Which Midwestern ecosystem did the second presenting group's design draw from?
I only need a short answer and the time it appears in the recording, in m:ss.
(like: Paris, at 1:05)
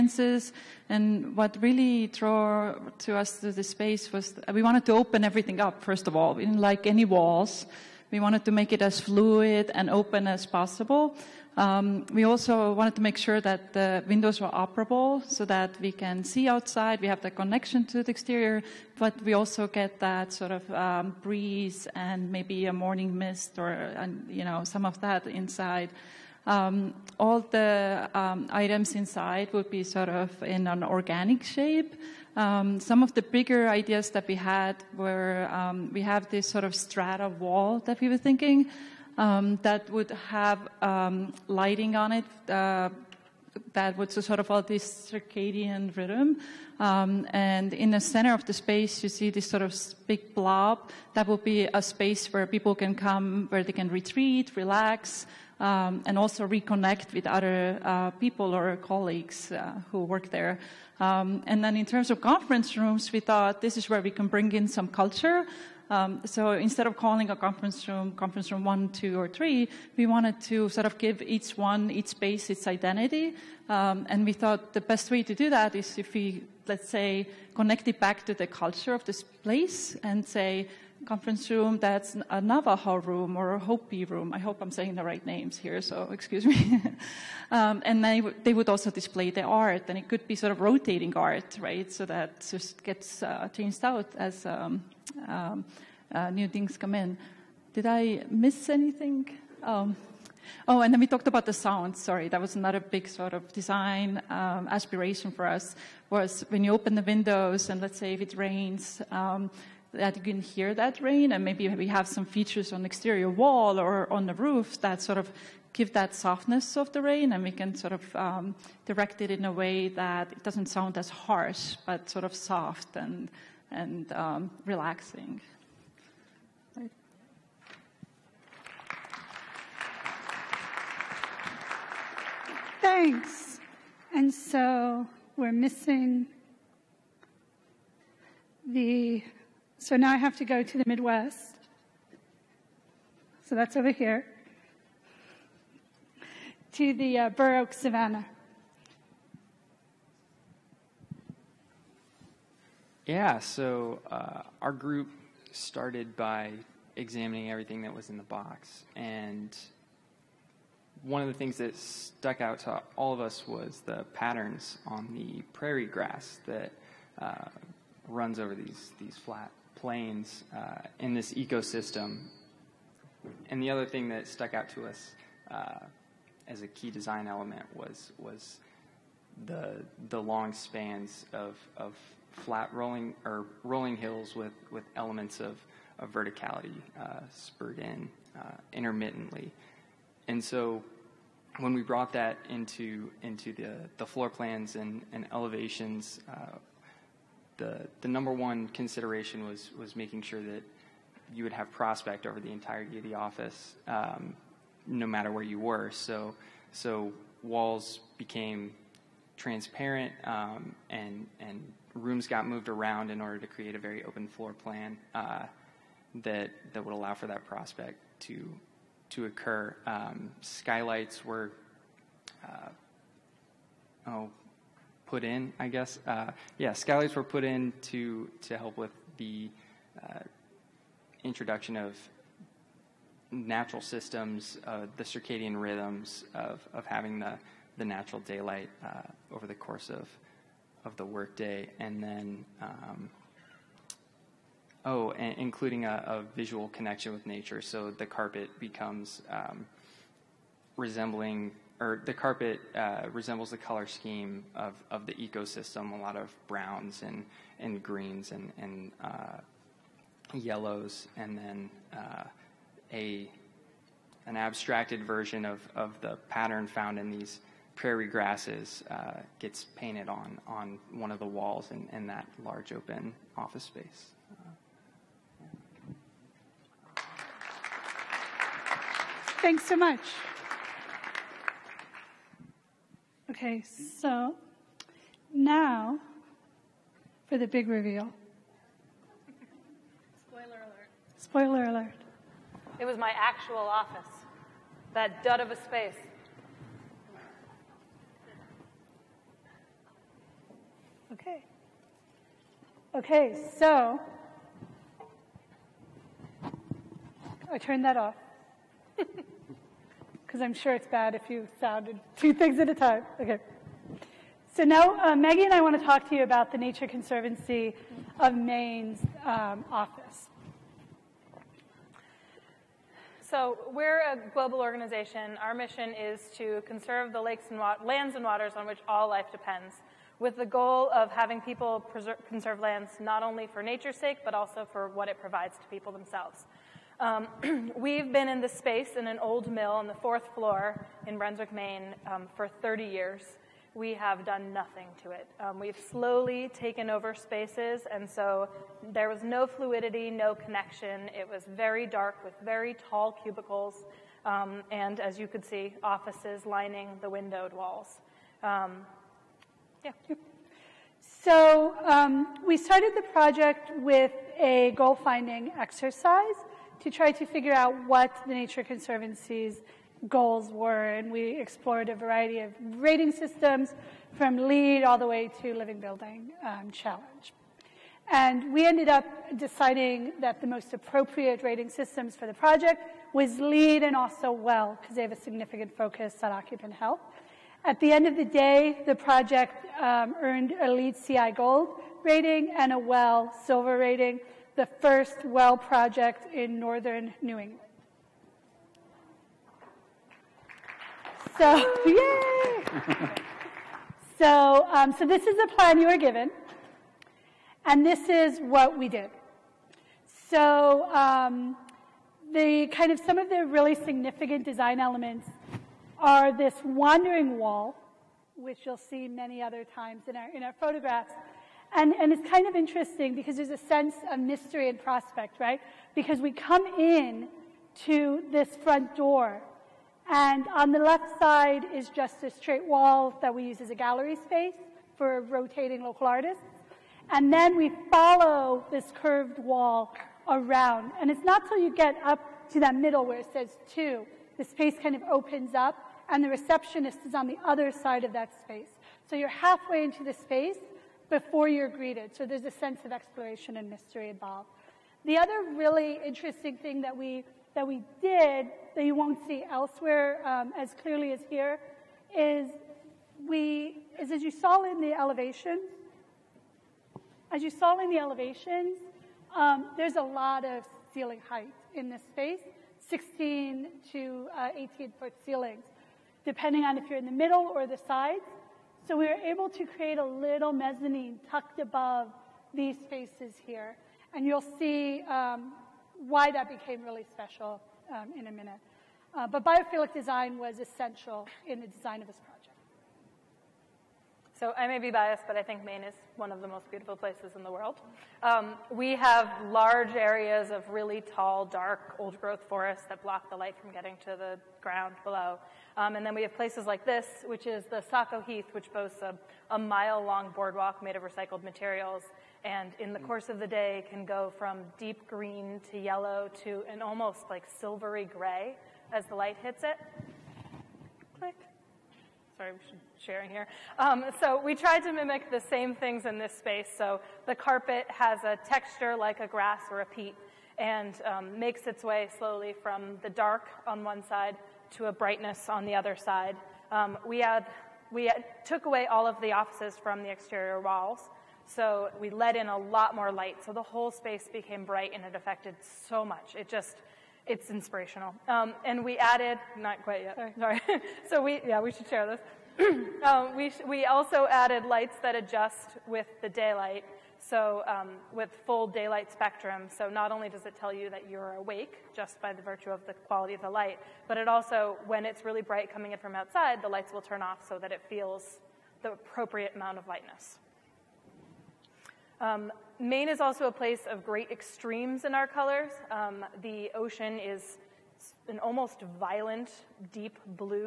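Burr Oak Savannah, at 2:27.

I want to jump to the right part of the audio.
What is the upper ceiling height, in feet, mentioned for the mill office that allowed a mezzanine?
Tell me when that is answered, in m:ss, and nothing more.
7:54.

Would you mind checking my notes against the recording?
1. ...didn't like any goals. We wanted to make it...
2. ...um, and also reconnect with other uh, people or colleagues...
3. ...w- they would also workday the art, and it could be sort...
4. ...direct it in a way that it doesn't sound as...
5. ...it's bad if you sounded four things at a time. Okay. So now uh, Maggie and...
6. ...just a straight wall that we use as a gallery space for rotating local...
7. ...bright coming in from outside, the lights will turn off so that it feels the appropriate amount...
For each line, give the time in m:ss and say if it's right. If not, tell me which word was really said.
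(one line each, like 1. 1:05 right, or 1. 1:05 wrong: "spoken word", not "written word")
1. 0:06 wrong: "walls", not "goals"
2. 0:55 right
3. 1:28 wrong: "display", not "workday"
4. 1:58 right
5. 5:10 wrong: "two", not "four"
6. 7:11 right
7. 9:25 right.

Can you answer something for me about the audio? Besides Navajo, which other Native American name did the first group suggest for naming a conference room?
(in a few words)
Hopi.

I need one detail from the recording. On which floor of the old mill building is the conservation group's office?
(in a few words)
Fourth floor.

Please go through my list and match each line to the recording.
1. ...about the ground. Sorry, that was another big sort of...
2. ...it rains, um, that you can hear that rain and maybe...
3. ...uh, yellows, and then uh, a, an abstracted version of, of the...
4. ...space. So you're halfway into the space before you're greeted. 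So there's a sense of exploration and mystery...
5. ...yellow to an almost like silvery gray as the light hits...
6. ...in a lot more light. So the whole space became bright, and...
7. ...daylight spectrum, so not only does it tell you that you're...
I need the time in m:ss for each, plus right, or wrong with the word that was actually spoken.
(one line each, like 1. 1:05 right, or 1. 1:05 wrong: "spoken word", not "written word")
1. 1:41 wrong: "sound", not "ground"
2. 1:48 right
3. 4:19 right
4. 7:28 right
5. 8:35 right
6. 9:02 right
7. 9:18 right.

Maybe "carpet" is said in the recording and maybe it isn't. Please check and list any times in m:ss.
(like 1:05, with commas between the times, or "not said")
4:08, 4:12, 8:47.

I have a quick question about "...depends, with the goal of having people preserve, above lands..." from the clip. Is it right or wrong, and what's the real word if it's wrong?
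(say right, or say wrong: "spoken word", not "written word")
wrong: "conserve", not "above".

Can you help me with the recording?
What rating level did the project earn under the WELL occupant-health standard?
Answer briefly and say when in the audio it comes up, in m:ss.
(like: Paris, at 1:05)
Silver, at 6:32.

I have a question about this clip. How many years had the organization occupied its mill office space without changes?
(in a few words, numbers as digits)
30 years.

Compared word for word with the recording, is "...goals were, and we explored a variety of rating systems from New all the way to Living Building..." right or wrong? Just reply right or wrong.
wrong.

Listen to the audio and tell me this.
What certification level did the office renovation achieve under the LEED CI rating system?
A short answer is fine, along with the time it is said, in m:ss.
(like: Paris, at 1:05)
Gold, at 6:30.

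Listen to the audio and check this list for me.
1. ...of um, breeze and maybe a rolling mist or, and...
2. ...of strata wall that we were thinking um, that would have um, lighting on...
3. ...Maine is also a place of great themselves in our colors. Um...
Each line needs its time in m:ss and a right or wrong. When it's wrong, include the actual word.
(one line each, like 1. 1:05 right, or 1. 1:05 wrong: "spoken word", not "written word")
1. 0:20 wrong: "morning", not "rolling"
2. 0:36 right
3. 9:32 wrong: "extremes", not "themselves".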